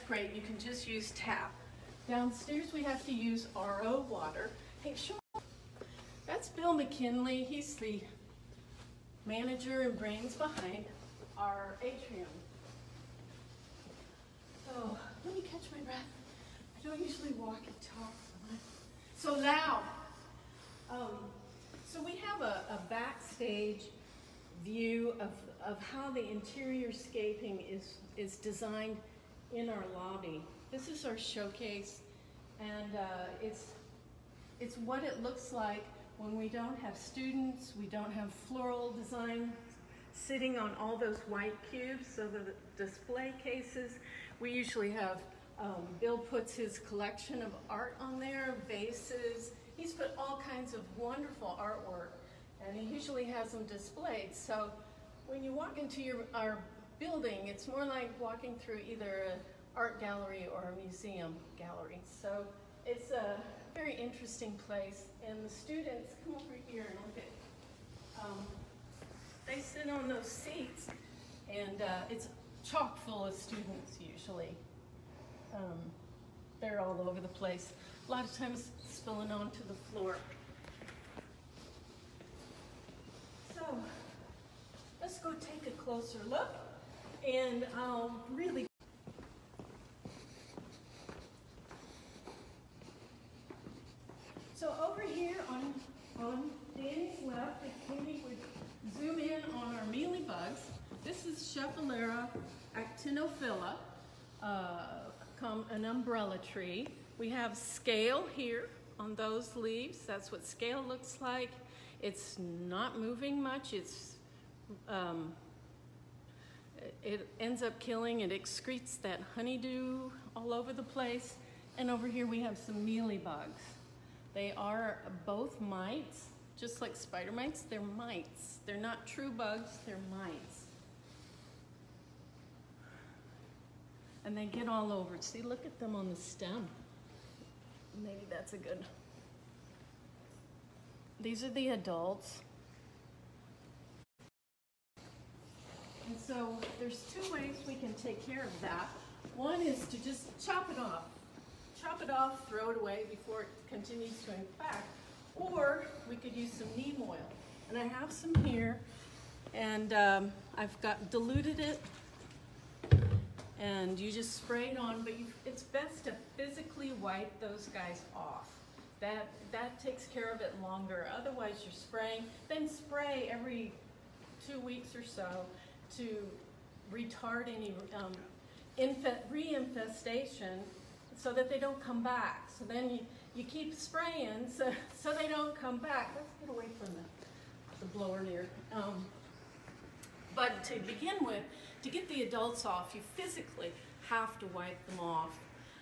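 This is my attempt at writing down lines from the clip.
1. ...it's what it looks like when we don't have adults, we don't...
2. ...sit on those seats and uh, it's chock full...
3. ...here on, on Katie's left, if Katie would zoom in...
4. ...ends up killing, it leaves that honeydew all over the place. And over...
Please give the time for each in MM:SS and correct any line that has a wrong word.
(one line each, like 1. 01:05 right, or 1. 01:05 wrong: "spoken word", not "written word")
1. 00:34 wrong: "students", not "adults"
2. 01:09 right
3. 01:35 wrong: "Danny", not "Katie"
4. 01:57 wrong: "excretes", not "leaves".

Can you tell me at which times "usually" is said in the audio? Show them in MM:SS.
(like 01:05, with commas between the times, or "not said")
00:16, 00:44, 00:52, 01:14.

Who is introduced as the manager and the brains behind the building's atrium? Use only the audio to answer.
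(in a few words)
Bill McKinley.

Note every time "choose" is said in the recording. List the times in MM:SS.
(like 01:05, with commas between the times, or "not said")
not said.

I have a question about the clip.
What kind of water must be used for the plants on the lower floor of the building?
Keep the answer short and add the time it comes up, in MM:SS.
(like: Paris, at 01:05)
RO water, at 00:03.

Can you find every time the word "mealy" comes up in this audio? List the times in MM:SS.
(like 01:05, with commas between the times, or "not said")
01:39, 02:02.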